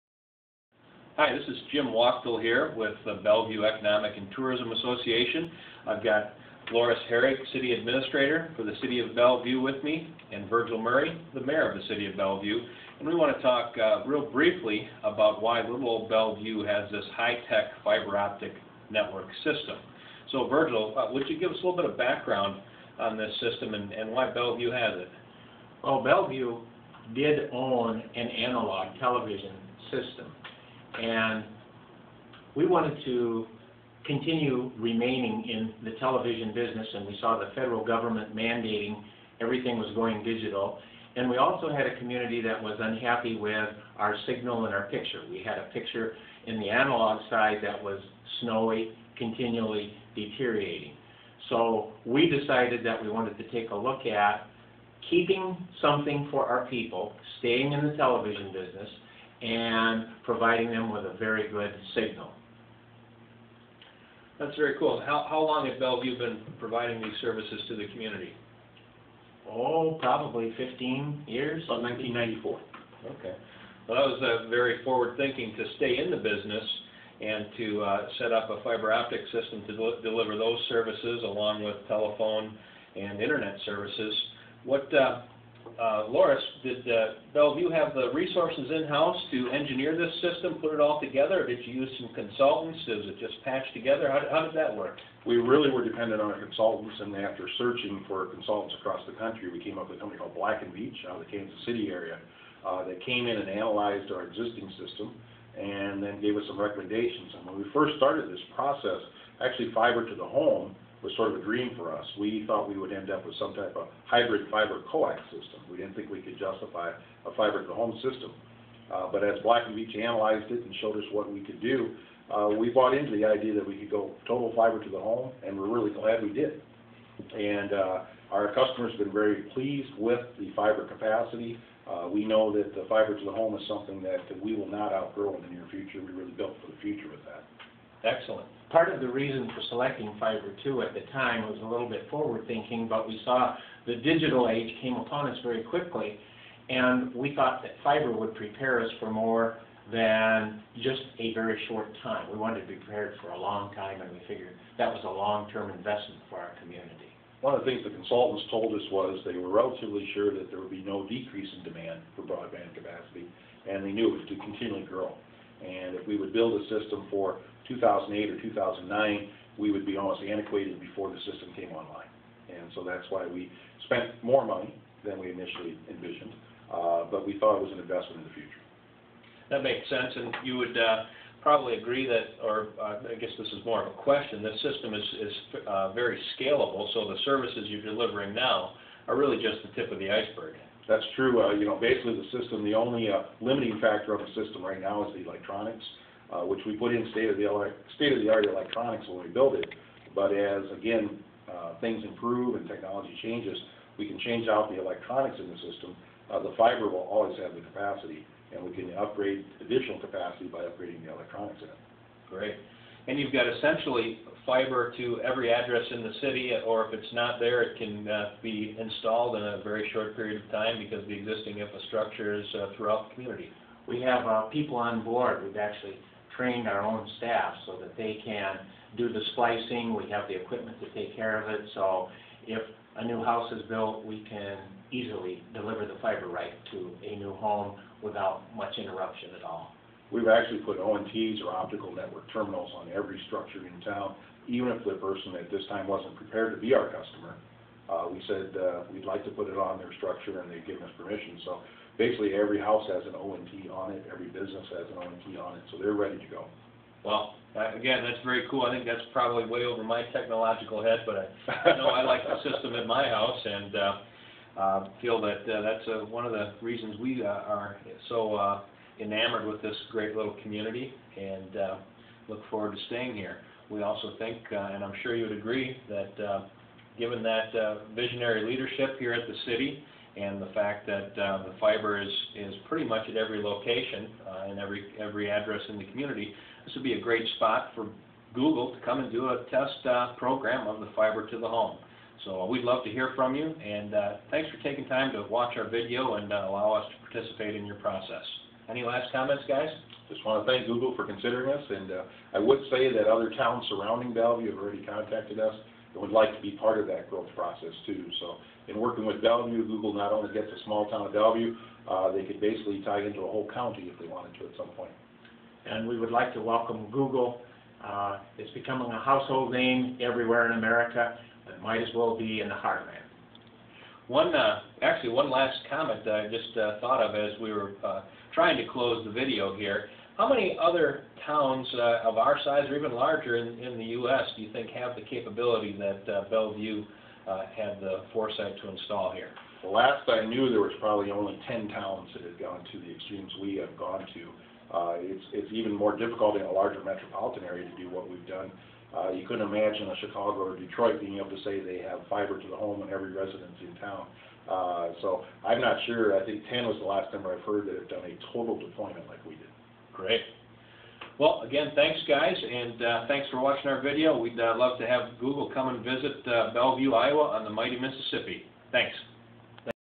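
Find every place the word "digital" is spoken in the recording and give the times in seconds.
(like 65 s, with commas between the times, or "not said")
40 s, 143 s.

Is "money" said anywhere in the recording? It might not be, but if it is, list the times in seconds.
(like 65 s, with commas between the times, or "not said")
174 s.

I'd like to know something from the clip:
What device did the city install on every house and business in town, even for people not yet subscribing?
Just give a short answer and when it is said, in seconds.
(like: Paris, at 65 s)
Optical network terminals, at 241 s.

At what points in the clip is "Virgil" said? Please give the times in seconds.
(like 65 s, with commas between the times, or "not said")
10 s, 20 s.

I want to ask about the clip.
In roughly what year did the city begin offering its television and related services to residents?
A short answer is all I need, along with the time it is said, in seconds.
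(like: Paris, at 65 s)
1994, at 71 s.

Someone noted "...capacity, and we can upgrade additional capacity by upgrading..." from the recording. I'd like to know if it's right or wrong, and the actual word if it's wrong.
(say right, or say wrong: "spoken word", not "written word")
right.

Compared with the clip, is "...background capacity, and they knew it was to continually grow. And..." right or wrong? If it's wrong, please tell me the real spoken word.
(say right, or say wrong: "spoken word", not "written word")
wrong: "broadband", not "background".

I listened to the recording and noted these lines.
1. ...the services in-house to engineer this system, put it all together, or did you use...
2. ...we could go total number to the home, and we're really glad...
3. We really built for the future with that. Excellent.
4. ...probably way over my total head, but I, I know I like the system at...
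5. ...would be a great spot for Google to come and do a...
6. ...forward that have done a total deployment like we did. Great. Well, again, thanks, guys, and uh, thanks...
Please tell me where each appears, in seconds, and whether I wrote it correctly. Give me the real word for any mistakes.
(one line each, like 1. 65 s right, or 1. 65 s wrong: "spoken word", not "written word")
1. 87 s wrong: "resources", not "services"
2. 123 s wrong: "fiber", not "number"
3. 136 s right
4. 259 s wrong: "technological", not "total"
5. 286 s right
6. 357 s wrong: "heard", not "forward".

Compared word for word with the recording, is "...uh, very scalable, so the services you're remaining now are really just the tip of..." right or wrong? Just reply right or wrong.
wrong.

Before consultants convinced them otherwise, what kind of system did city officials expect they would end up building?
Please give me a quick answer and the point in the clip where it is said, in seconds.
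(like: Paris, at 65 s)
Hybrid fiber coax, at 114 s.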